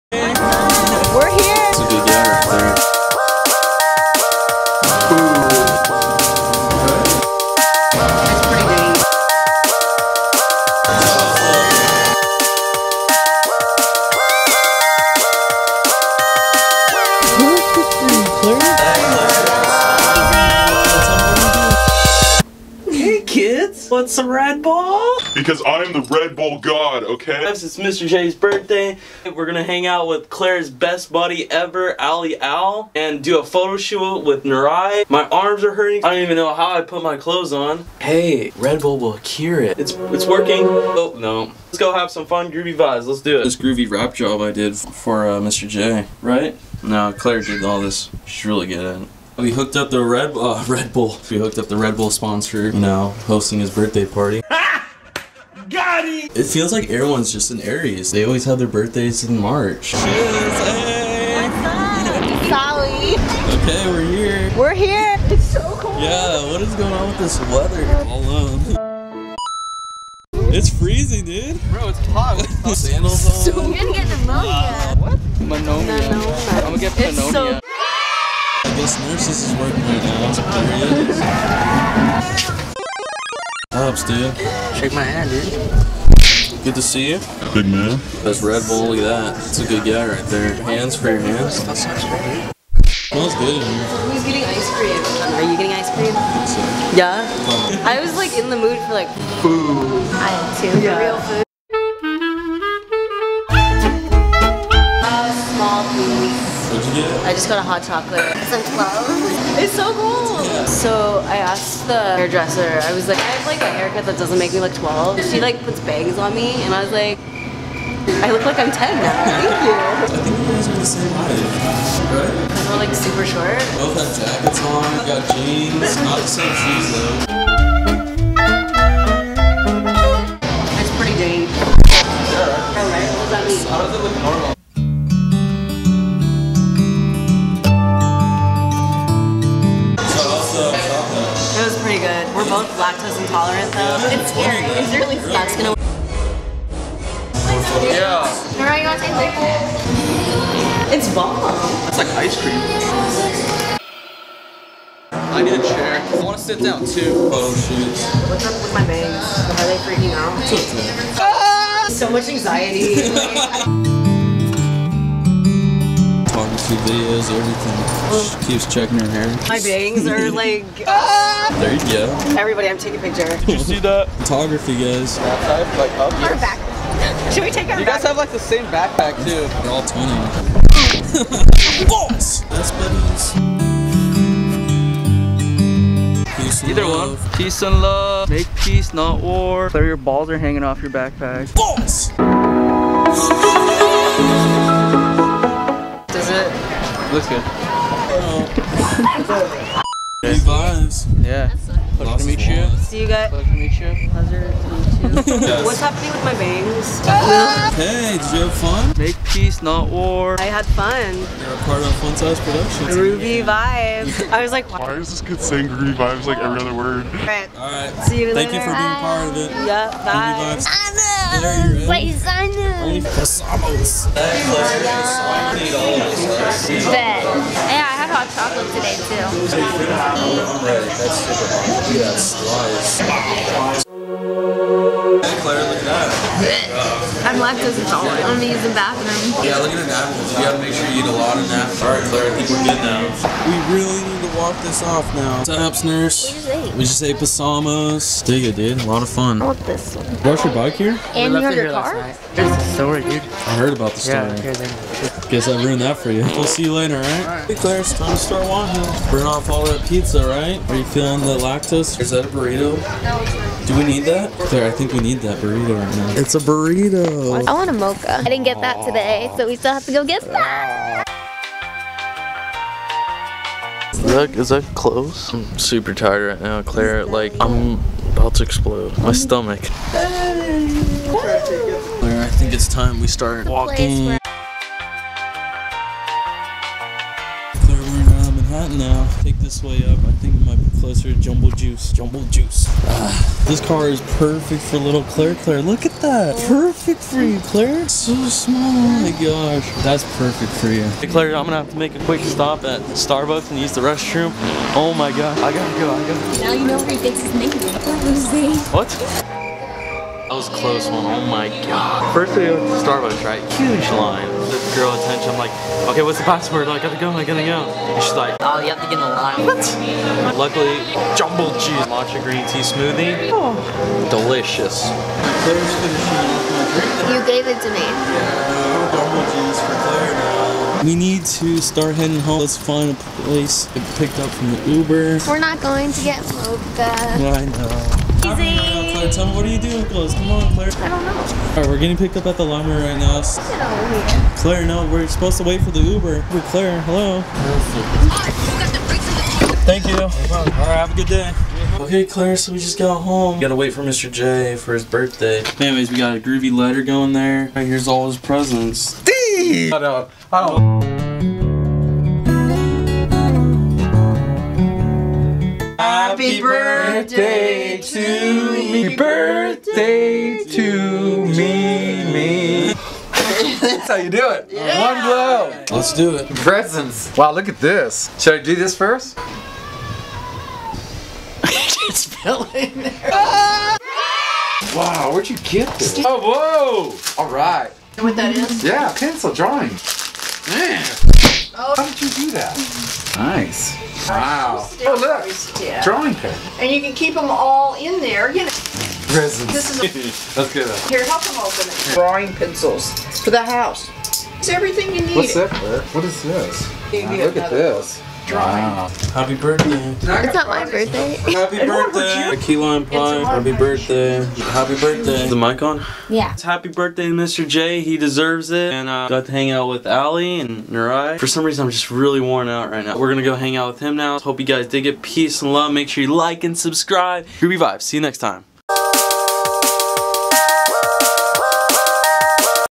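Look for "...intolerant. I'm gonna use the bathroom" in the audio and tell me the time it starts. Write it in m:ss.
3:57.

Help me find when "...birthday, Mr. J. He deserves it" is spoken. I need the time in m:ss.
6:56.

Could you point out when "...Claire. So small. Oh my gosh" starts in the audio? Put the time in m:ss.
4:57.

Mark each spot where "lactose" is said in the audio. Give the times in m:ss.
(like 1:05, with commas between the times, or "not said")
3:57, 4:21.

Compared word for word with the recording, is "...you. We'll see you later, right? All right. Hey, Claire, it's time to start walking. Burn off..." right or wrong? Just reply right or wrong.
right.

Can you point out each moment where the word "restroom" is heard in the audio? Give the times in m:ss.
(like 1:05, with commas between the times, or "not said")
5:03.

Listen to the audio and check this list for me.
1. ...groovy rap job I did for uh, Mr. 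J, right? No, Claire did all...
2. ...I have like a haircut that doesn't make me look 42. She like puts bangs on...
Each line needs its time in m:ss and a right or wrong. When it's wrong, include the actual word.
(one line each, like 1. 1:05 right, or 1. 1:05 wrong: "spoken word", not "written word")
1. 0:43 right
2. 1:53 wrong: "12", not "42".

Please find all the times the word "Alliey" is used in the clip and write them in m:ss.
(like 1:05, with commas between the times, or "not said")
0:31, 6:59.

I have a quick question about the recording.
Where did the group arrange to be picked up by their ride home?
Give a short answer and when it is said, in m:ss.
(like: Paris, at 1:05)
The library, at 5:42.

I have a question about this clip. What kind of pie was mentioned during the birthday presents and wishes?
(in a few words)
Key lime pie.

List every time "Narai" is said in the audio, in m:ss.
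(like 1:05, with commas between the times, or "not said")
0:34, 7:00.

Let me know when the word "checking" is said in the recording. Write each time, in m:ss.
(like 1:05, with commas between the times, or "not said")
2:48.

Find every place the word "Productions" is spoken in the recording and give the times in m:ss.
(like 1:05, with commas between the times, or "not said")
3:32.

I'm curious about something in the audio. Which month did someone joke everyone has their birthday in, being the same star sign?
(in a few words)
March.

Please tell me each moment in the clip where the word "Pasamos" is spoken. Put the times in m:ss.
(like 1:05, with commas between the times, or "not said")
3:43, 4:07.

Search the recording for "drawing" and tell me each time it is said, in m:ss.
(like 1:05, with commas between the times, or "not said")
6:29, 6:35, 6:41, 6:48.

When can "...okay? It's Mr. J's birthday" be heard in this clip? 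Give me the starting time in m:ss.
0:27.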